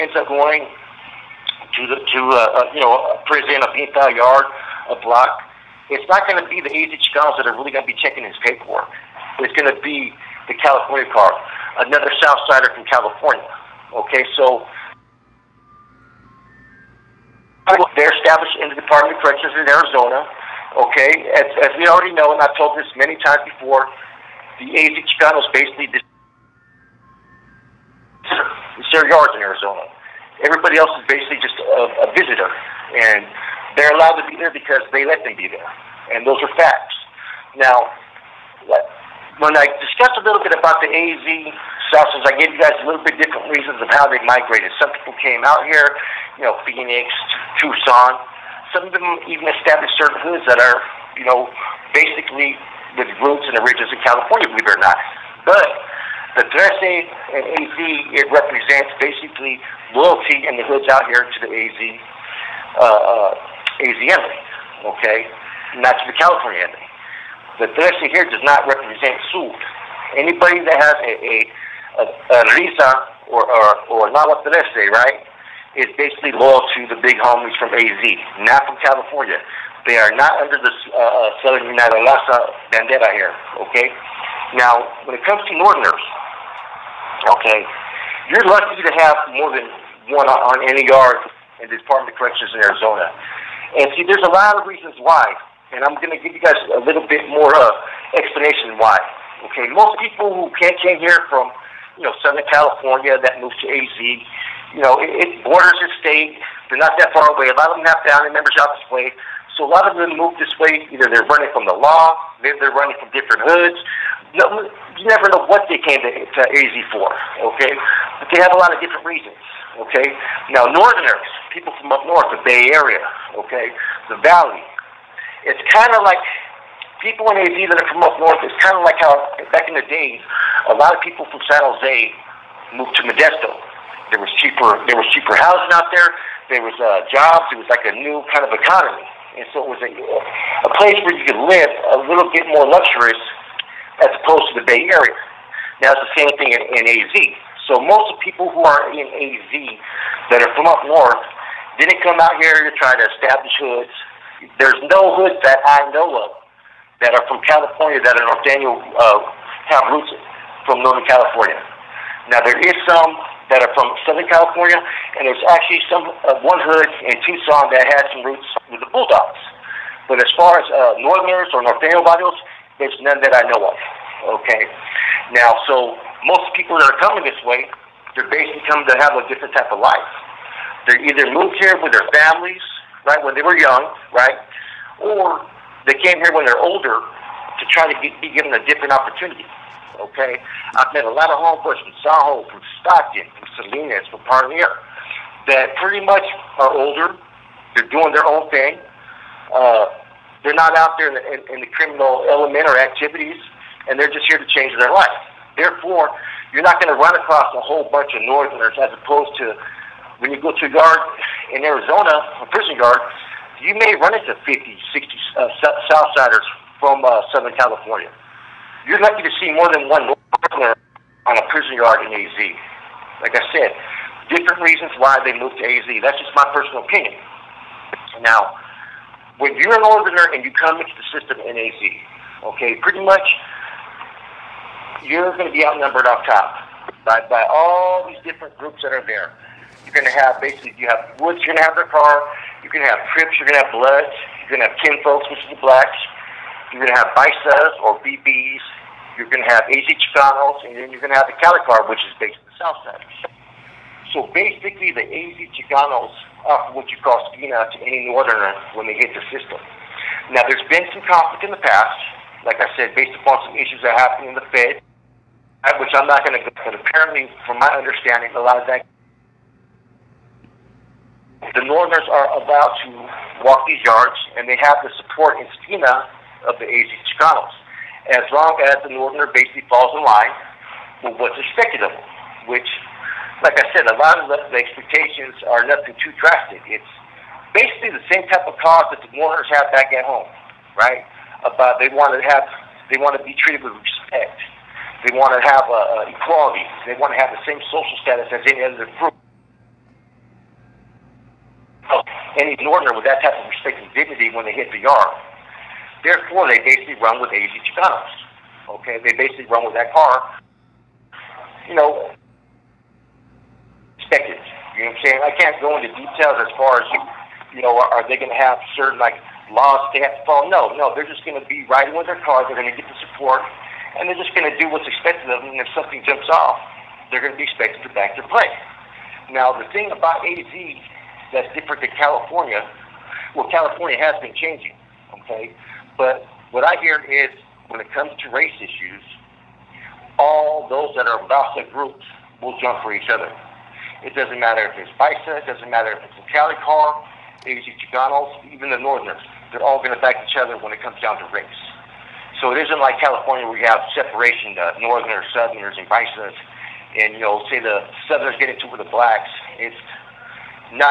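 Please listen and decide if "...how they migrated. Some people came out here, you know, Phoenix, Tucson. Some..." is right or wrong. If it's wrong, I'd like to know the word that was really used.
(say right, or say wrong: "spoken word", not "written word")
right.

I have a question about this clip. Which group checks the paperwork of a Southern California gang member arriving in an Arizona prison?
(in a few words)
California car.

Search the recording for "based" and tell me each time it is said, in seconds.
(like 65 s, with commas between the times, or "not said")
252 s, 262 s.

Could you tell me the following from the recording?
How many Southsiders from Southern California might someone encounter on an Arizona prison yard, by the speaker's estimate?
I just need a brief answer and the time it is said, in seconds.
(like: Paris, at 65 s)
50 to 60, at 214 s.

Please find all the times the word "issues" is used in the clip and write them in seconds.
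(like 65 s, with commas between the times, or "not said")
263 s, 338 s.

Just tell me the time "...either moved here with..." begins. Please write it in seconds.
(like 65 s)
181 s.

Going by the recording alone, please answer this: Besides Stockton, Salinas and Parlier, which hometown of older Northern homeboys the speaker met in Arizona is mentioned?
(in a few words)
Saho.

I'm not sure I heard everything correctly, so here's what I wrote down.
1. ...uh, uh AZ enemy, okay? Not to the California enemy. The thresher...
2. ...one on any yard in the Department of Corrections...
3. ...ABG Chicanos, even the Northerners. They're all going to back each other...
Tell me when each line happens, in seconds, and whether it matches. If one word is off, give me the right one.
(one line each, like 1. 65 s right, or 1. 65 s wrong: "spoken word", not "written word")
1. 62 s right
2. 90 s right
3. 347 s right.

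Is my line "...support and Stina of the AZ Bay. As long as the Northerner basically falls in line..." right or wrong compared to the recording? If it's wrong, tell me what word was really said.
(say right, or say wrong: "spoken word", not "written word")
wrong: "Chicanos", not "Bay".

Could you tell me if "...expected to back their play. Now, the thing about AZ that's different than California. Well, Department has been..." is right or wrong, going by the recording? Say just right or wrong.
wrong.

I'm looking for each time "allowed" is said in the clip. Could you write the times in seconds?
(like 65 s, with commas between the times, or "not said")
33 s.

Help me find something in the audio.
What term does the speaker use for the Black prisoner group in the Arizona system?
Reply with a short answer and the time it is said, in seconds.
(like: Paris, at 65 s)
kinfolks, at 244 s.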